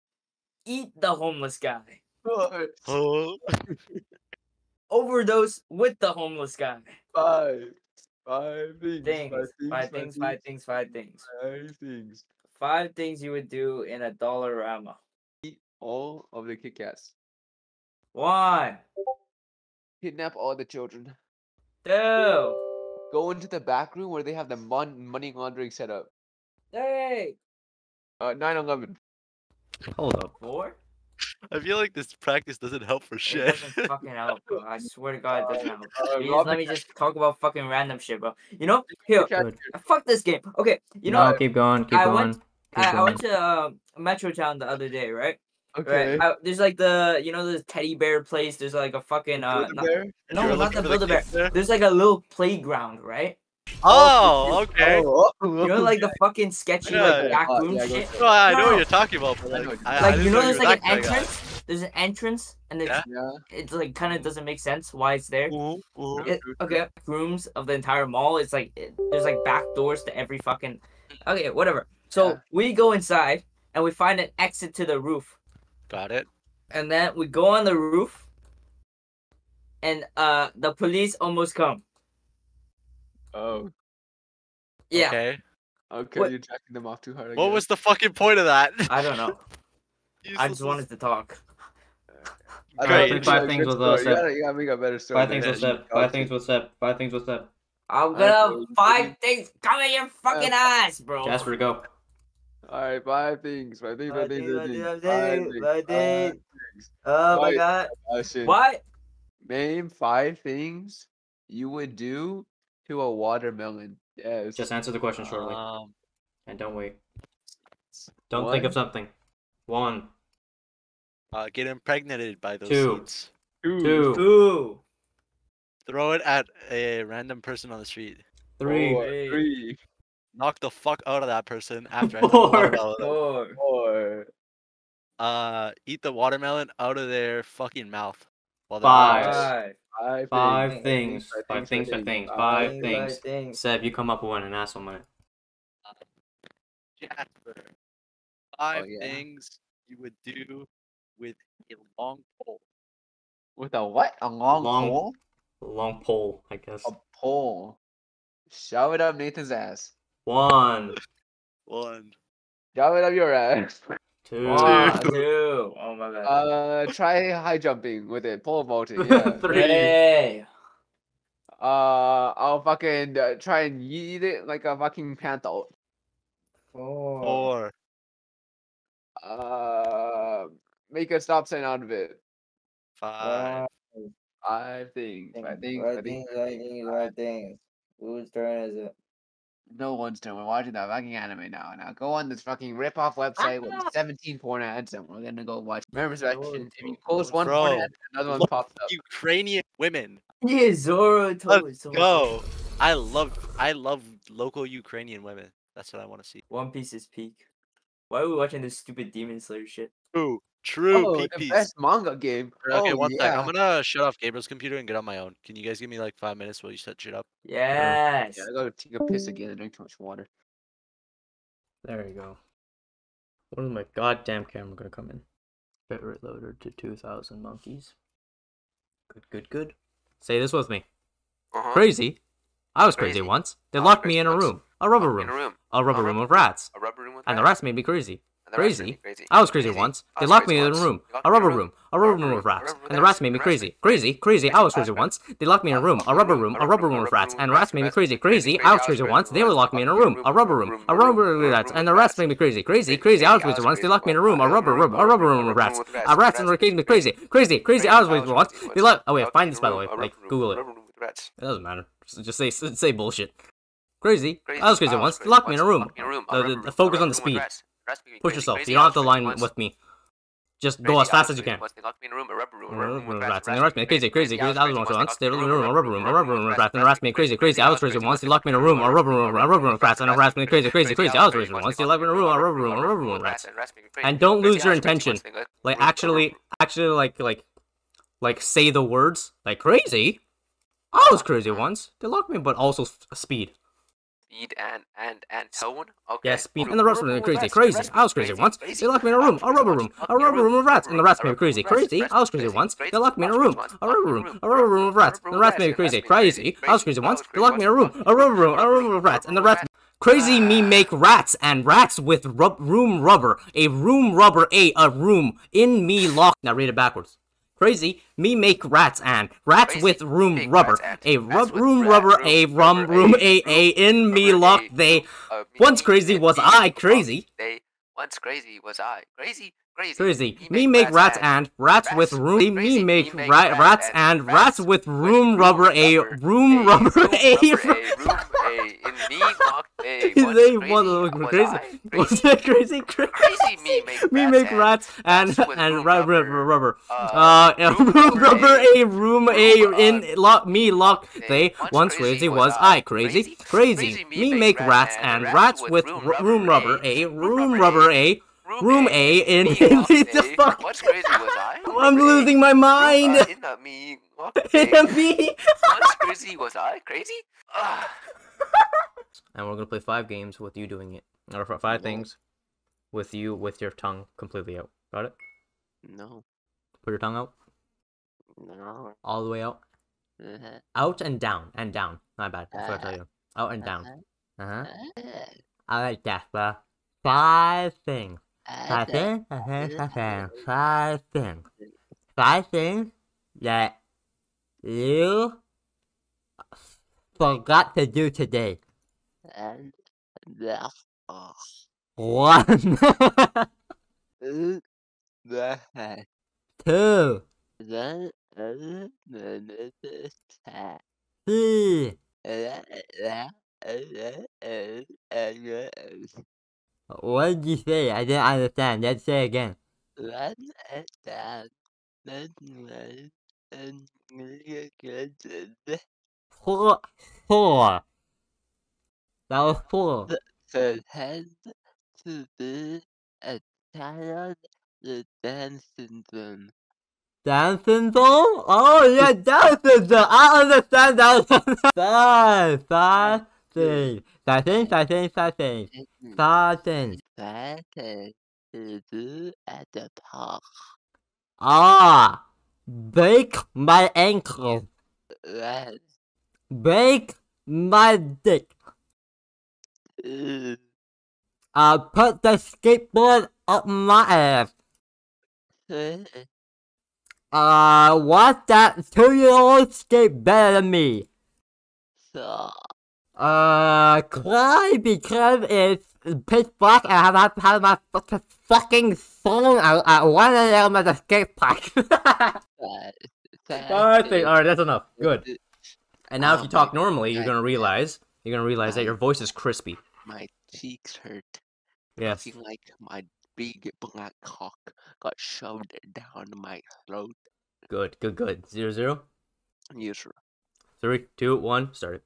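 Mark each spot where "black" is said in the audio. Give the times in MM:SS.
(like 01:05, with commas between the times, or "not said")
07:56, 08:13.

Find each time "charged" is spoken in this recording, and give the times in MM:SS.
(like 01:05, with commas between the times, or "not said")
not said.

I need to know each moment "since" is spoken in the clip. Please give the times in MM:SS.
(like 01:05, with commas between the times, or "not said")
not said.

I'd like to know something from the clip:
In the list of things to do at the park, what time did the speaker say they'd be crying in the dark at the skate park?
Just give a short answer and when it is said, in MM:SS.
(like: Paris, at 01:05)
1 a.m., at 08:00.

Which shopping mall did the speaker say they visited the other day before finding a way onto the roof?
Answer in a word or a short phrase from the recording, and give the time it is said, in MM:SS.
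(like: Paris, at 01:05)
Metrotown, at 00:43.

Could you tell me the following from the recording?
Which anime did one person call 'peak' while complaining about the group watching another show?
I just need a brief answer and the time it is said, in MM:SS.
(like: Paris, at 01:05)
One Piece, at 03:26.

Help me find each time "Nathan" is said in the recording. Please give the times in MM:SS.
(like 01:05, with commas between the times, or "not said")
02:39.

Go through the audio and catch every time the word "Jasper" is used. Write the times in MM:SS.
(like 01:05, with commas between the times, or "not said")
01:41, 02:26, 06:26.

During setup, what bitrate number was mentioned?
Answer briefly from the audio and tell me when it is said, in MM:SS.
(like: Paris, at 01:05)
2,000, at 03:46.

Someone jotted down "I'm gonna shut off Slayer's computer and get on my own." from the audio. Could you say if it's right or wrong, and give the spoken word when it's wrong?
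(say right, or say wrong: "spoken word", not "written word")
wrong: "Gabriel", not "Slayer".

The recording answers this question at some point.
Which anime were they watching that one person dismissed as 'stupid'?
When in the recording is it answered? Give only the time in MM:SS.
03:29.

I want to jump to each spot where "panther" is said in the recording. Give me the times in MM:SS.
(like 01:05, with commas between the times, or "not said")
02:55.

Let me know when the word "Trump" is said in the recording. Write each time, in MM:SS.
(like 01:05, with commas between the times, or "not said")
not said.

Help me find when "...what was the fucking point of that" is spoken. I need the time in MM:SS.
01:27.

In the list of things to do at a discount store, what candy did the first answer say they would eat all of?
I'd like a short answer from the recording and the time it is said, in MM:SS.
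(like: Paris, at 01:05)
Kit Kats, at 00:16.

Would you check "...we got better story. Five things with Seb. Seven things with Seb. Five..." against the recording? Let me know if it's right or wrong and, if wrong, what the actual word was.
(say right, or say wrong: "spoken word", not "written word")
wrong: "Five", not "Seven".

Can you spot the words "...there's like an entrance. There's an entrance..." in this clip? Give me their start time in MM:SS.
01:00.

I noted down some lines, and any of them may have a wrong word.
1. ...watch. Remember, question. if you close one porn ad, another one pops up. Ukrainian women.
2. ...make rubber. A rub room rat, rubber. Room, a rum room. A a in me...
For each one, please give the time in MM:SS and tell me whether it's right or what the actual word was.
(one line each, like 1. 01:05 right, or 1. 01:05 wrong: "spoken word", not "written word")
1. 03:15 wrong: "section", not "question"
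2. 05:20 right.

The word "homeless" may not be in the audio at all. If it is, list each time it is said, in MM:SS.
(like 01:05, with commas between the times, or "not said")
00:01, 00:06.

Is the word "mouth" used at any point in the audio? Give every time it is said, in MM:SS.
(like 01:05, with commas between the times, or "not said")
02:17.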